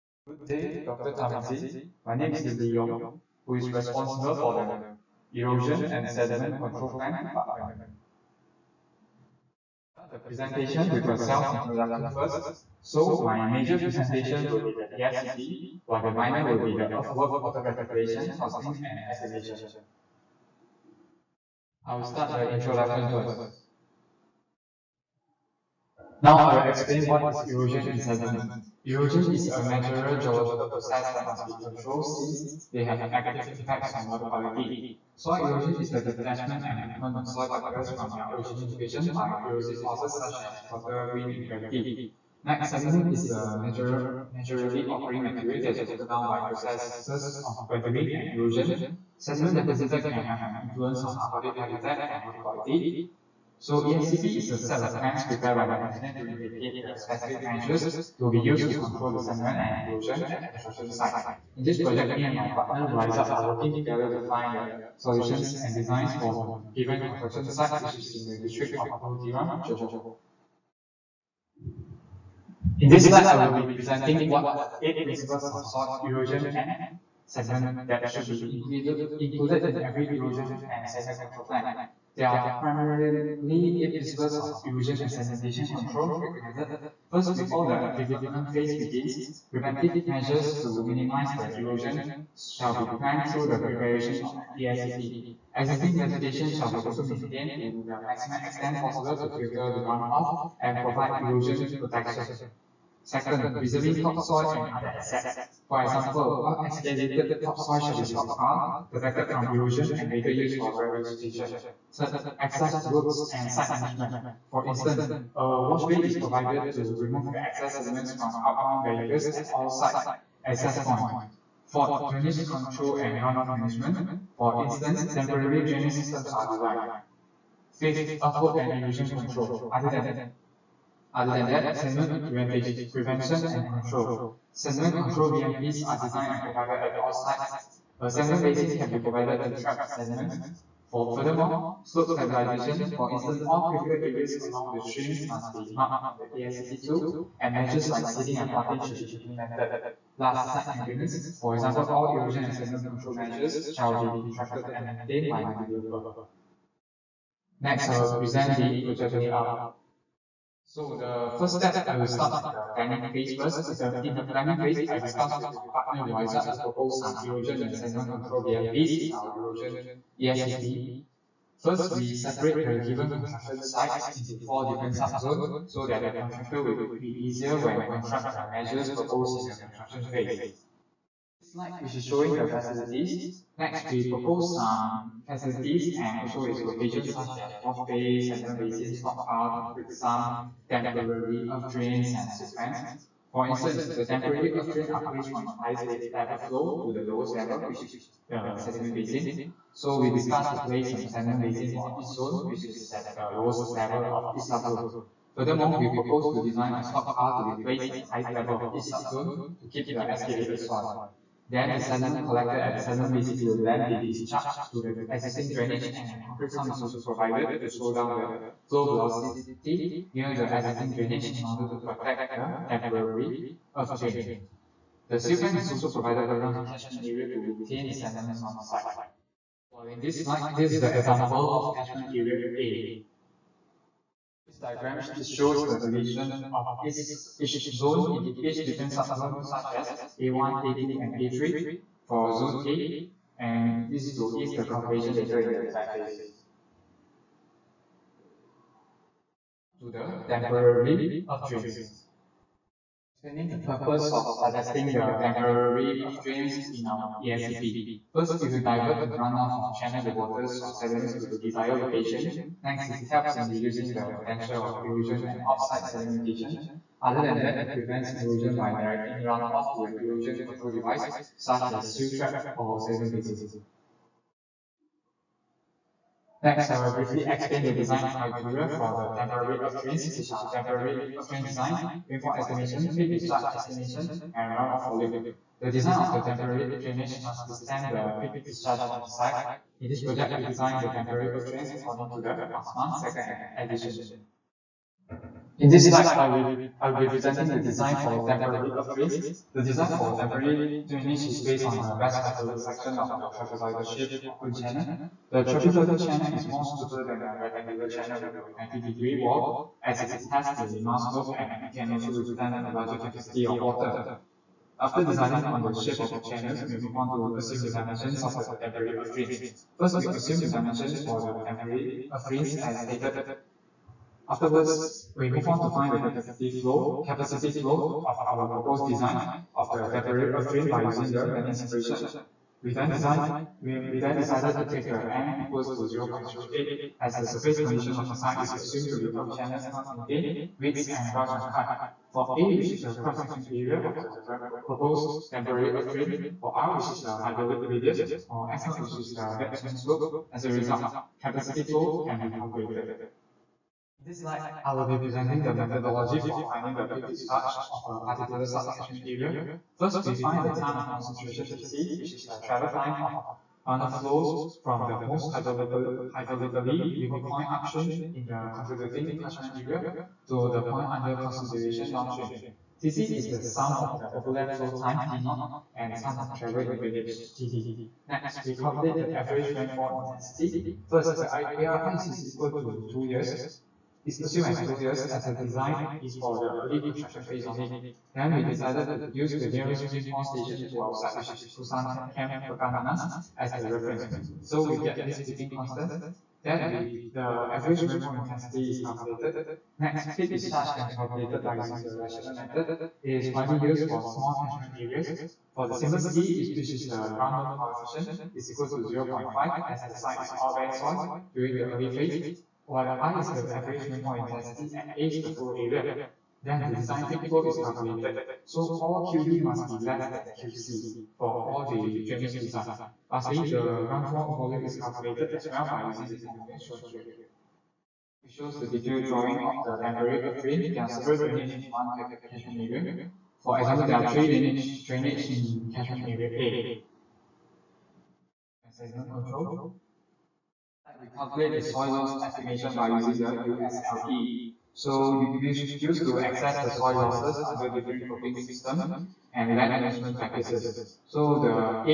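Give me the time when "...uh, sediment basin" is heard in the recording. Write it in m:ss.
3:18.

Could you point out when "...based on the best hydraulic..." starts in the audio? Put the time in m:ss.
5:01.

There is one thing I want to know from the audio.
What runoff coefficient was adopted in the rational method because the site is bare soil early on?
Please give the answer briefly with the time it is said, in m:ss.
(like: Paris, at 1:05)
0.5, at 6:48.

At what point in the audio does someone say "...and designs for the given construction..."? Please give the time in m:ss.
1:05.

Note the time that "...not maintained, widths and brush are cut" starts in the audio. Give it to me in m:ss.
5:39.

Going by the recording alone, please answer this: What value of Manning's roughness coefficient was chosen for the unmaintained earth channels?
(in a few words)
0.08.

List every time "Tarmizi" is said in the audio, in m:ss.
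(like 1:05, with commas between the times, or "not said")
0:01.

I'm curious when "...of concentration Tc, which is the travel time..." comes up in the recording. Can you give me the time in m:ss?
6:00.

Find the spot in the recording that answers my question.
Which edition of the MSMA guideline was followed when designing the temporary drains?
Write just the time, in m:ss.
4:52.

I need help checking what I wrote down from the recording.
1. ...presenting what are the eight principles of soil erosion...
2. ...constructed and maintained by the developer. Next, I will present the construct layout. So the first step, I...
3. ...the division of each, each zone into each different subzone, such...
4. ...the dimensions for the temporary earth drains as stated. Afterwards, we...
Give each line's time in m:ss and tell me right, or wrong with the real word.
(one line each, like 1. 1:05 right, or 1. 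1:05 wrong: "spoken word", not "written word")
1. 1:13 right
2. 2:34 wrong: "project", not "construct"
3. 3:55 right
4. 5:20 right.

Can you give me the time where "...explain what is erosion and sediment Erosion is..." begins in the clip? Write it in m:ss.
0:26.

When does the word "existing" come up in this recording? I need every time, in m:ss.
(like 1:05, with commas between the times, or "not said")
1:35, 3:35, 3:40.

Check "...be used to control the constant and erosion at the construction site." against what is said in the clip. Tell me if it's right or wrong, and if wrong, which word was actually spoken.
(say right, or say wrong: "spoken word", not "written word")
wrong: "sediment", not "constant".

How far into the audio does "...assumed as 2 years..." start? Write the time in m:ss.
6:24.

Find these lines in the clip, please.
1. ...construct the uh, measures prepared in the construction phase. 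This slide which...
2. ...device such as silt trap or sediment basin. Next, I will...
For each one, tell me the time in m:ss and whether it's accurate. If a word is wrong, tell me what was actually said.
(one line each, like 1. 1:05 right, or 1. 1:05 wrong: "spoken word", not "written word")
1. 2:57 wrong: "proposed", not "prepared"
2. 4:30 right.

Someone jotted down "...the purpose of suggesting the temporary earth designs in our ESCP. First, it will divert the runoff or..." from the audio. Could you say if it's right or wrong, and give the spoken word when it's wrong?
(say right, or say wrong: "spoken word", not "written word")
wrong: "drains", not "designs".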